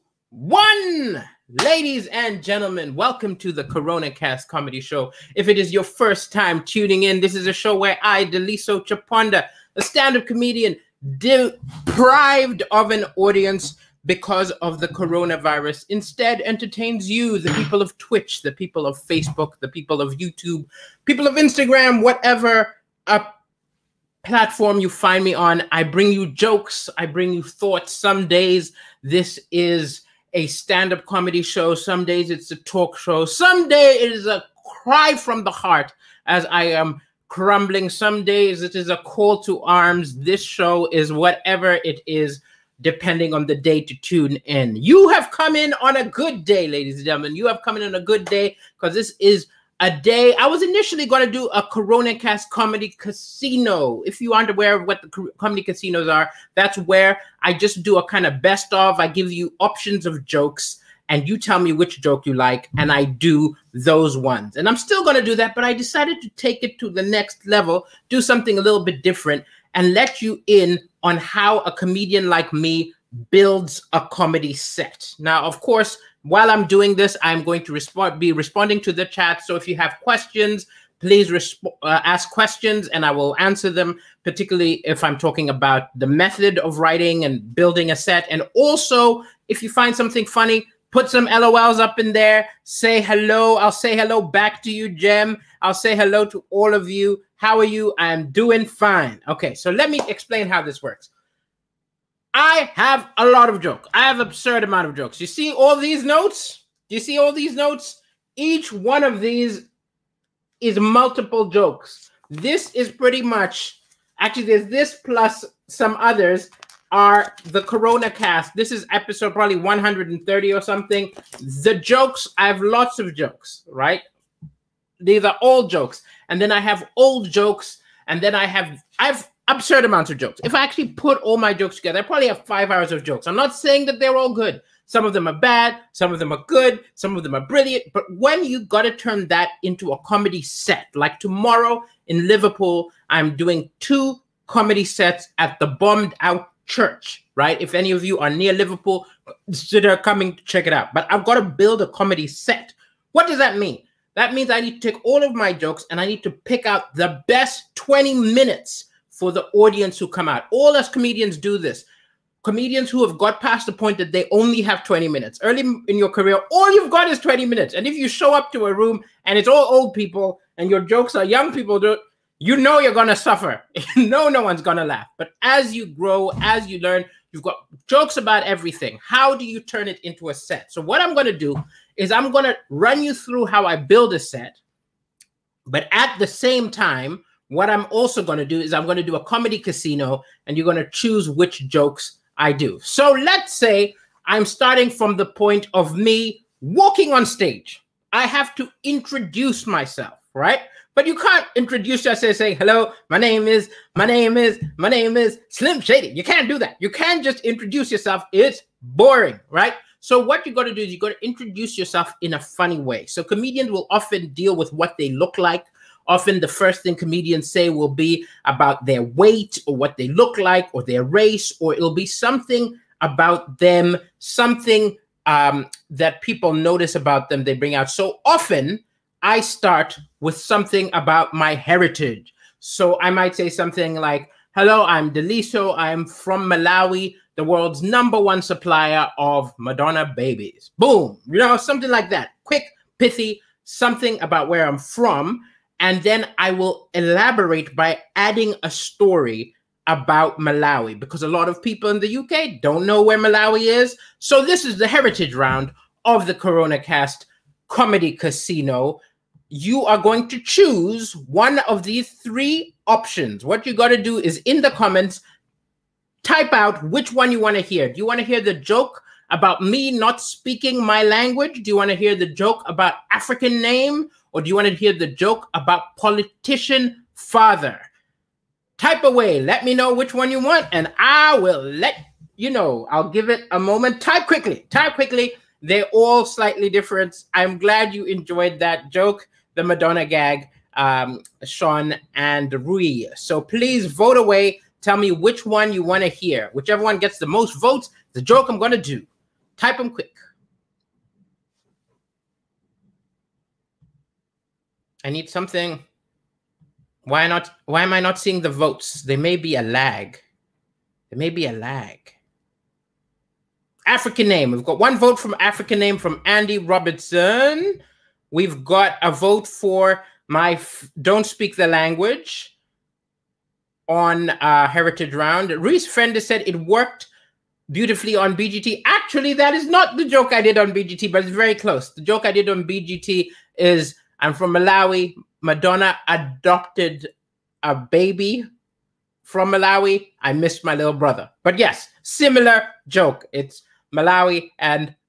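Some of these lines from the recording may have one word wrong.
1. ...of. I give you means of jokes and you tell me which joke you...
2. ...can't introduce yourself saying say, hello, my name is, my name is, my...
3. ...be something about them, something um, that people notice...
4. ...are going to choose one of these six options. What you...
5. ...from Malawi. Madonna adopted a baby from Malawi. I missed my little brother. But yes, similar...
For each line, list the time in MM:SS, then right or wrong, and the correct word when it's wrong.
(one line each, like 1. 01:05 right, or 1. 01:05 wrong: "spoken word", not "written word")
1. 00:58 wrong: "options", not "means"
2. 03:21 right
3. 03:41 right
4. 04:19 wrong: "three", not "six"
5. 05:34 right.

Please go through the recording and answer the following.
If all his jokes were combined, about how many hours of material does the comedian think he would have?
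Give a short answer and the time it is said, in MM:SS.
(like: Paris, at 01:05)
5 hours, at 02:12.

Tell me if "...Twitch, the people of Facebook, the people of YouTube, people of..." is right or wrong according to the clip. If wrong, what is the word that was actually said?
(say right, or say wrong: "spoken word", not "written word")
right.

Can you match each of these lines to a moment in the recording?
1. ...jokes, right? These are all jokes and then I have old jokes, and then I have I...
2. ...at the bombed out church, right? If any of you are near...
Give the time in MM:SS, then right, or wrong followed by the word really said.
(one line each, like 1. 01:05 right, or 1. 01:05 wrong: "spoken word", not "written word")
1. 02:03 right
2. 02:25 right.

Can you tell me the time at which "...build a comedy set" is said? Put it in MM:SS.
02:31.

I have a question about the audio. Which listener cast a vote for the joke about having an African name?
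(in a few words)
Andy Robertson.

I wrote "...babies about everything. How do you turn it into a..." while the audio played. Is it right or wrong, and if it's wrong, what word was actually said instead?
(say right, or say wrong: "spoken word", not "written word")
wrong: "jokes", not "babies".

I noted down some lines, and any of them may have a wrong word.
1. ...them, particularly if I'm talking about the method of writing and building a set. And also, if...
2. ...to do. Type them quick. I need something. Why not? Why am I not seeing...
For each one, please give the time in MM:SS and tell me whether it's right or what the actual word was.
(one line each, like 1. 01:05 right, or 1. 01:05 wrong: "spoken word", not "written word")
1. 01:23 right
2. 04:58 right.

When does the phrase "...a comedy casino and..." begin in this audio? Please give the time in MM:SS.
03:09.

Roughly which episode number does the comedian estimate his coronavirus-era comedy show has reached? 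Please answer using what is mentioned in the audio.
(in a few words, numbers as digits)
130.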